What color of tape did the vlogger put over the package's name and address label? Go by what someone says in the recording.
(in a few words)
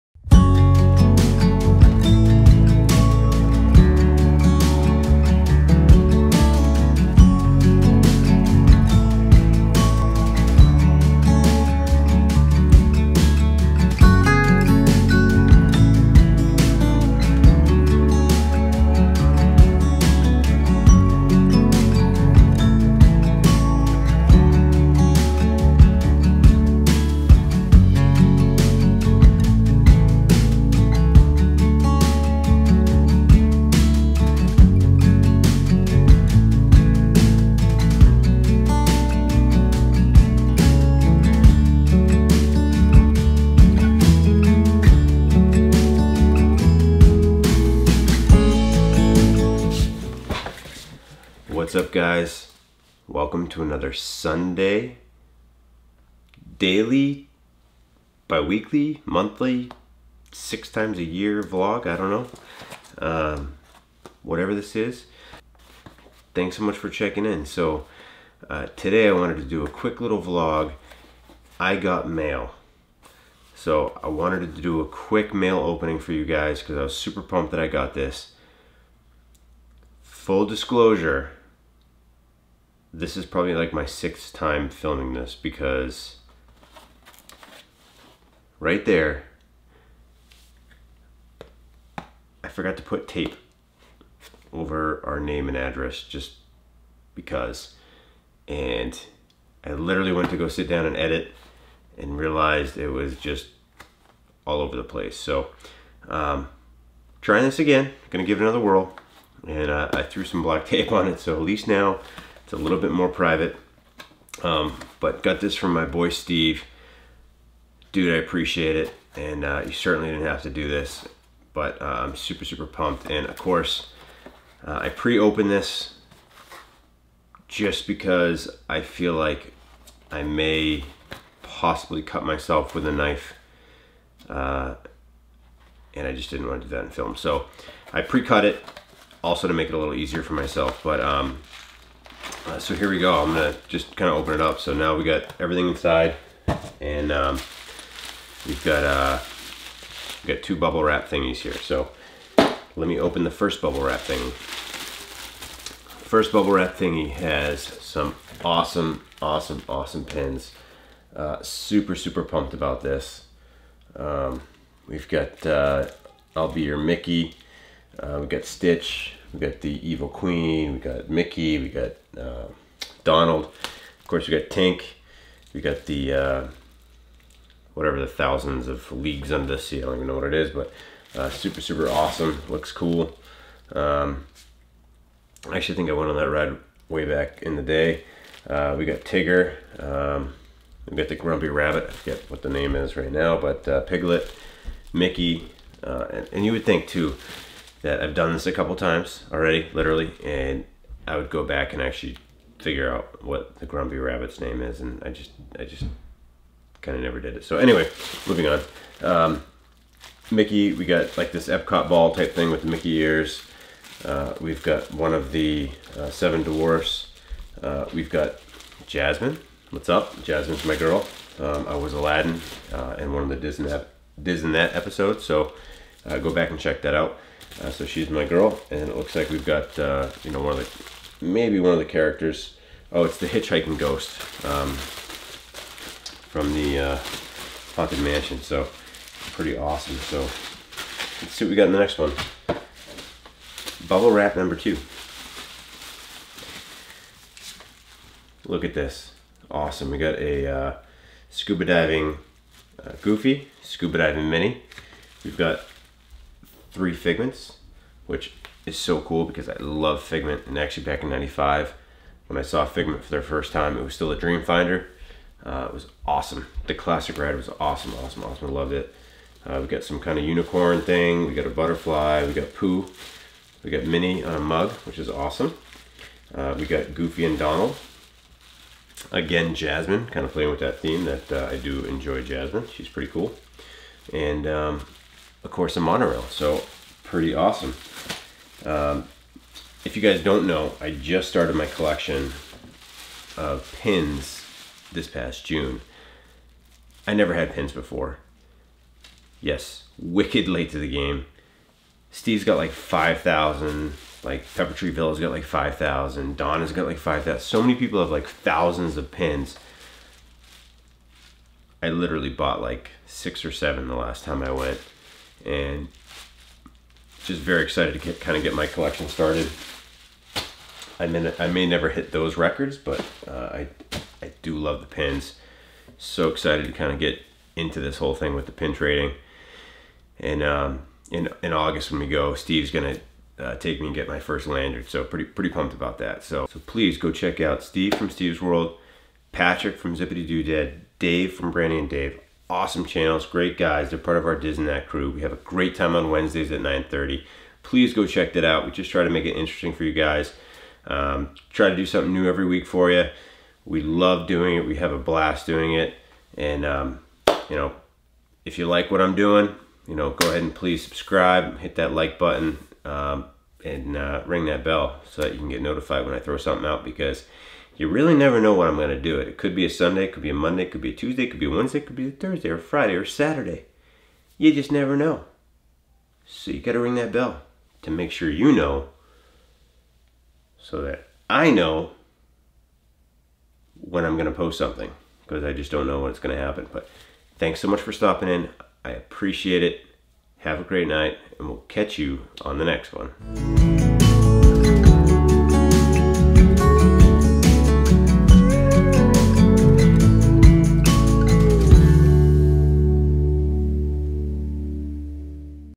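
Black.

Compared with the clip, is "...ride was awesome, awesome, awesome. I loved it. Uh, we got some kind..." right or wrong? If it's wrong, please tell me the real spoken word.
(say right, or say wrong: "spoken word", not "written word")
right.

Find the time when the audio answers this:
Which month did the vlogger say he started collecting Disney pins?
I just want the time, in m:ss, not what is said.
4:55.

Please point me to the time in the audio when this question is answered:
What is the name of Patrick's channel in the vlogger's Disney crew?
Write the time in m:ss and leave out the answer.
5:39.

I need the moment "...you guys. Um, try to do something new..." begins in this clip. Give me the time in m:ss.
5:49.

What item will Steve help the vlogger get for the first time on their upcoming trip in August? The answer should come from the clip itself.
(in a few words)
Lanyard.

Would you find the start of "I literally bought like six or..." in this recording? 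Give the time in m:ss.
5:11.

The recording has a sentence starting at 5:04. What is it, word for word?
Like Pepper Tree Villa's got like 5,000.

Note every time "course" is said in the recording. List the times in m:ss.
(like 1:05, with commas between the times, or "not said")
2:03, 2:54, 4:45.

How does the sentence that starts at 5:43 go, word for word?
They're part of our Disney crew.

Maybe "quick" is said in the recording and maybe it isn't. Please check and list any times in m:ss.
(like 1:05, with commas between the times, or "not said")
1:09, 1:14.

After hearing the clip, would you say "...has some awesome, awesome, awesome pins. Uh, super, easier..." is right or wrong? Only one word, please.
wrong.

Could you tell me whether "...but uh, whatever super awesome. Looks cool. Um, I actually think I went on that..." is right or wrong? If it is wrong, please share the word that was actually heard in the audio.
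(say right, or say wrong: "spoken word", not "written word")
wrong: "super", not "whatever".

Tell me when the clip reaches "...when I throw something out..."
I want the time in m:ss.
6:06.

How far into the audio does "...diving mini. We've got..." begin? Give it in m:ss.
4:13.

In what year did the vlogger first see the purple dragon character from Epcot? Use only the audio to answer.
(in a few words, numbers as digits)
1995.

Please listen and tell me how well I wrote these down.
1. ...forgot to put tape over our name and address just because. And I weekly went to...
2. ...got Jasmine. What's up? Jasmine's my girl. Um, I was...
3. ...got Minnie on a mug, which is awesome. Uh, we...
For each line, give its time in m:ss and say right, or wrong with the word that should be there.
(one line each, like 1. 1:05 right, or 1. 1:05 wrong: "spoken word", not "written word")
1. 1:32 wrong: "literally", not "weekly"
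2. 3:38 right
3. 4:33 right.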